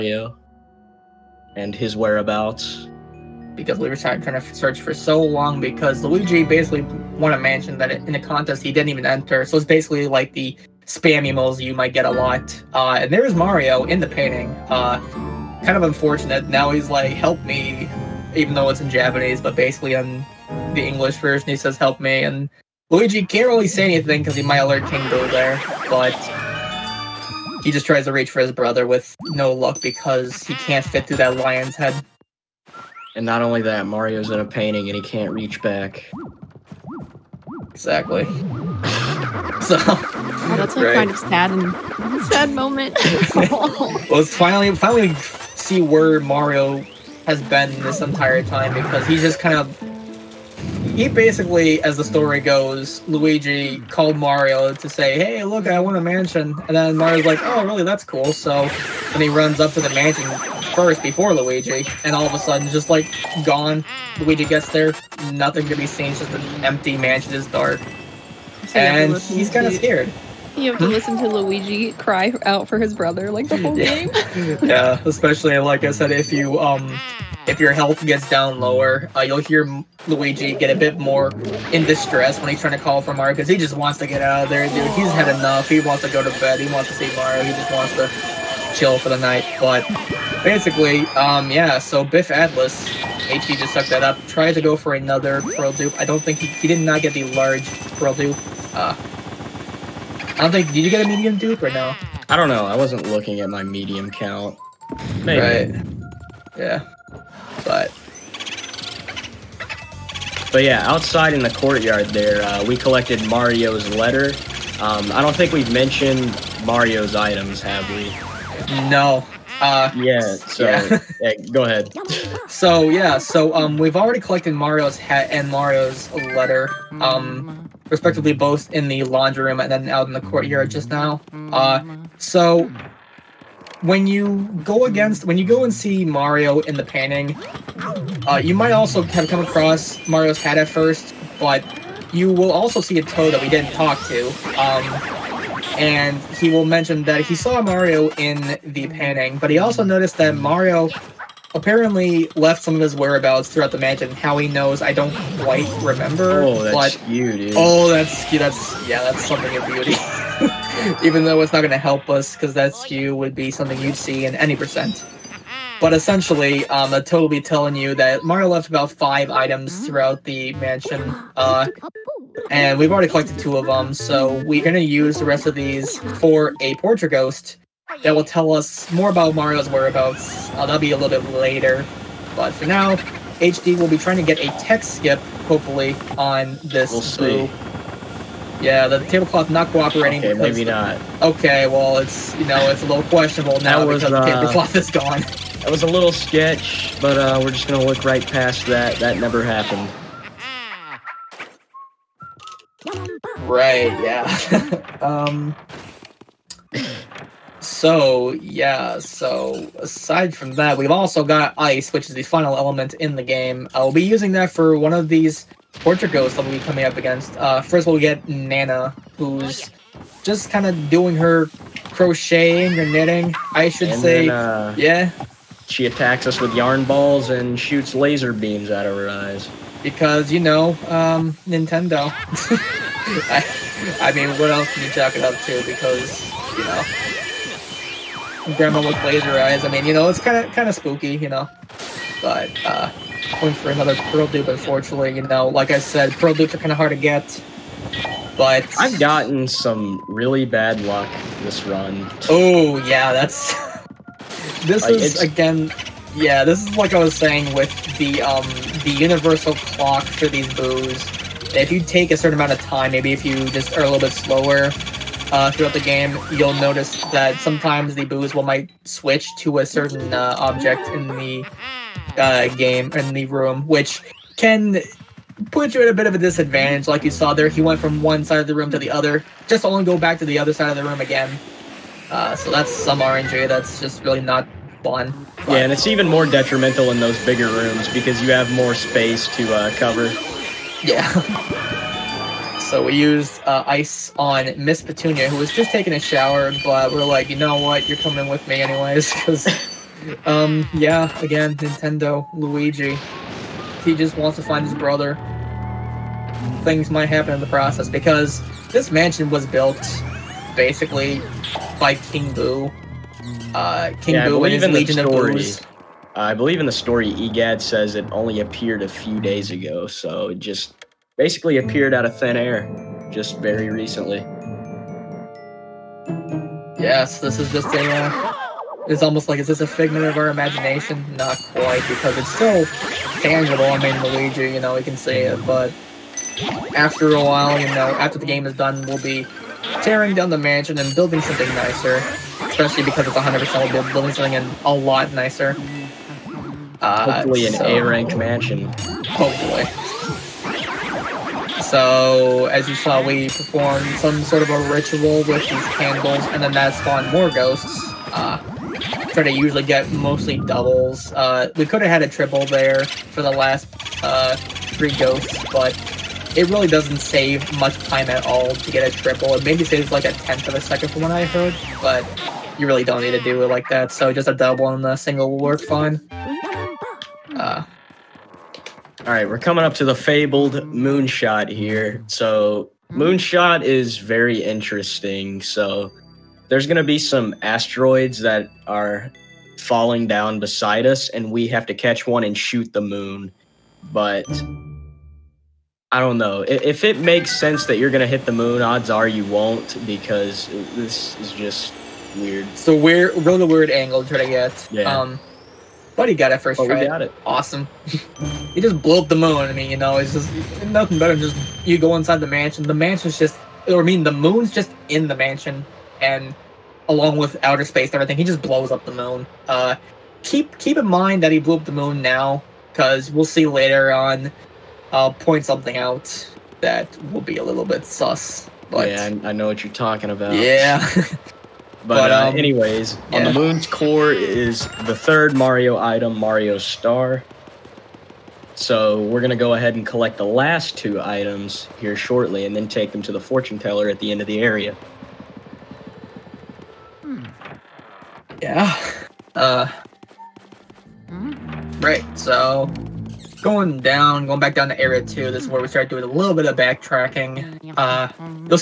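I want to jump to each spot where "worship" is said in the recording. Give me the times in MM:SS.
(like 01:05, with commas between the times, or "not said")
not said.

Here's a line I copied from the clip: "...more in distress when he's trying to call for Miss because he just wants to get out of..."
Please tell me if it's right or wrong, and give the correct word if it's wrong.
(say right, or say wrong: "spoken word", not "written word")
wrong: "Mario", not "Miss".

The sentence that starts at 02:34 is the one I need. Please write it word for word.
How he knows, I don't quite remember.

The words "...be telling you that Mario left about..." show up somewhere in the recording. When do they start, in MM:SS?
02:47.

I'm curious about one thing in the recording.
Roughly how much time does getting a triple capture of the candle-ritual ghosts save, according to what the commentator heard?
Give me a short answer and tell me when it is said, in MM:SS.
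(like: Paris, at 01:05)
a tenth of a second, at 06:10.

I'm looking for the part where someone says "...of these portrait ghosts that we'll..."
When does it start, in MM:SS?
03:34.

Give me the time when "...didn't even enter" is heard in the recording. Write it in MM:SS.
00:08.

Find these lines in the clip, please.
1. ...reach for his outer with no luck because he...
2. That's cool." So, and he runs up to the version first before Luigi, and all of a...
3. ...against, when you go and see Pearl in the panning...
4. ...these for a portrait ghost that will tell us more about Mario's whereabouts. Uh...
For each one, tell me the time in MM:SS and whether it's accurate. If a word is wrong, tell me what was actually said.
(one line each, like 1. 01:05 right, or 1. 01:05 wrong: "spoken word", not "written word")
1. 00:28 wrong: "brother", not "outer"
2. 00:57 wrong: "mansion", not "version"
3. 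02:14 wrong: "Mario", not "Pearl"
4. 02:55 right.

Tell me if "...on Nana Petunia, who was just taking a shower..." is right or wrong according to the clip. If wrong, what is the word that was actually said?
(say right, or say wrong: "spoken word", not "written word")
wrong: "Miss", not "Nana".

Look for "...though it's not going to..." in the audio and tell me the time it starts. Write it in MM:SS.
02:41.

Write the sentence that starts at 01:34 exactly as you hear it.
Tried to go for another Pearl Dupe.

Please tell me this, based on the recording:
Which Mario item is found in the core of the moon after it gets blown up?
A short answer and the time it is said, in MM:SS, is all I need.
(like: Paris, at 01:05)
Mario Star, at 07:16.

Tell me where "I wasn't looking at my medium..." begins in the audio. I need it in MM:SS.
01:42.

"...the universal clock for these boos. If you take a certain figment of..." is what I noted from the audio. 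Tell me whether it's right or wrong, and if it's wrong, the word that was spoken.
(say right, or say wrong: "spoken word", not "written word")
wrong: "amount", not "figment".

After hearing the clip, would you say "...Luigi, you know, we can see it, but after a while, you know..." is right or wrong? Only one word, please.
right.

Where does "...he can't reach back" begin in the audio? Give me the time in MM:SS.
00:34.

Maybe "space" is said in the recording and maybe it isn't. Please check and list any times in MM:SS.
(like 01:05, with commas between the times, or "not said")
04:48, 06:57.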